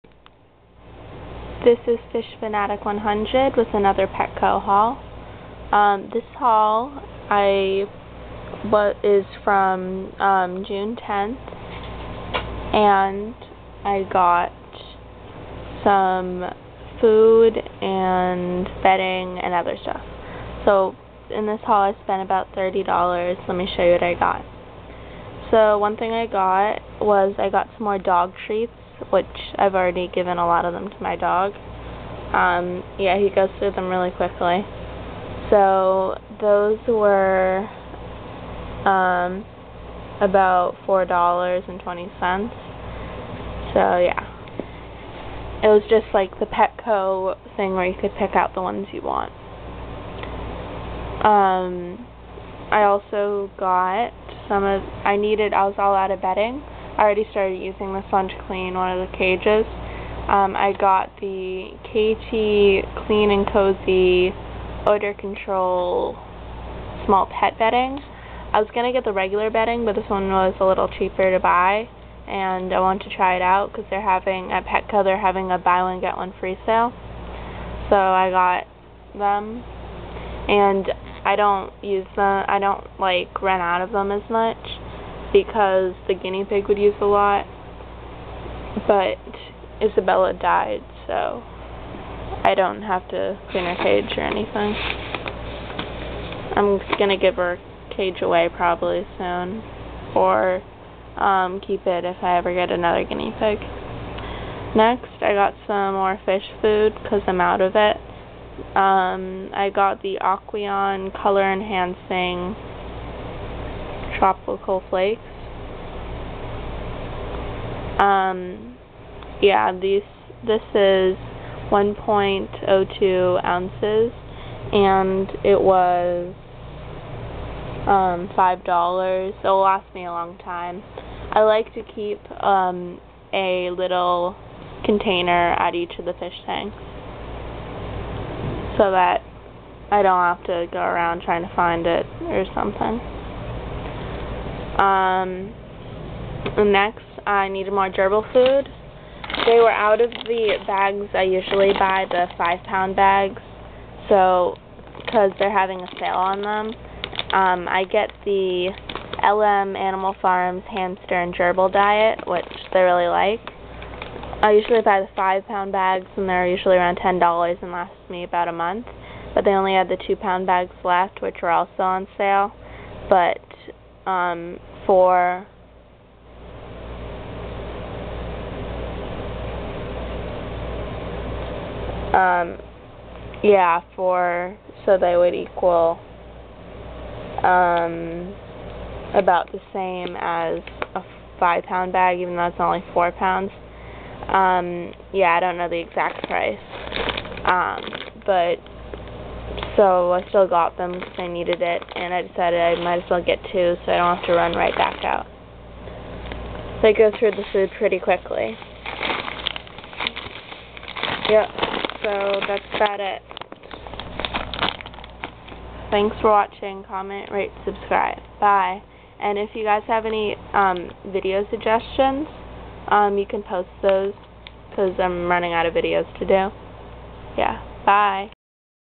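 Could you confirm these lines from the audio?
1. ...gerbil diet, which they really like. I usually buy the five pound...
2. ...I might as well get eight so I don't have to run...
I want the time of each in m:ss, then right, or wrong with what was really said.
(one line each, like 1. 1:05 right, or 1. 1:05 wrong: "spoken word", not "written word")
1. 2:41 right
2. 3:22 wrong: "two", not "eight".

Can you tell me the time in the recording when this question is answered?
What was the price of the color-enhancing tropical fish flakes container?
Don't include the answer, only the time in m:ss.
2:08.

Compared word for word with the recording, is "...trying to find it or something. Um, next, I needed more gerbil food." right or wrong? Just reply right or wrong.
right.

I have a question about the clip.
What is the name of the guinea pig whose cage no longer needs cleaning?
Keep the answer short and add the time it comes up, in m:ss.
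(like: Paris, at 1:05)
Isabella, at 1:29.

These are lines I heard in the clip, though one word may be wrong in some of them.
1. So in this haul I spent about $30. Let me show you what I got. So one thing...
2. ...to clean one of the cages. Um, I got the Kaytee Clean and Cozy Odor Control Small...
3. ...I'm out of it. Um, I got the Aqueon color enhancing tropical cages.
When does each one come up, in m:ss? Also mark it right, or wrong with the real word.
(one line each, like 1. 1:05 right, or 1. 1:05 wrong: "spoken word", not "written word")
1. 0:20 right
2. 0:58 right
3. 1:47 wrong: "flakes", not "cages".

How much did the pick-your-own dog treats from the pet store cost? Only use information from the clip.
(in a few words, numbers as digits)
$4.20.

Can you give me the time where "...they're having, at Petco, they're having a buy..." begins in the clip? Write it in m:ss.
1:13.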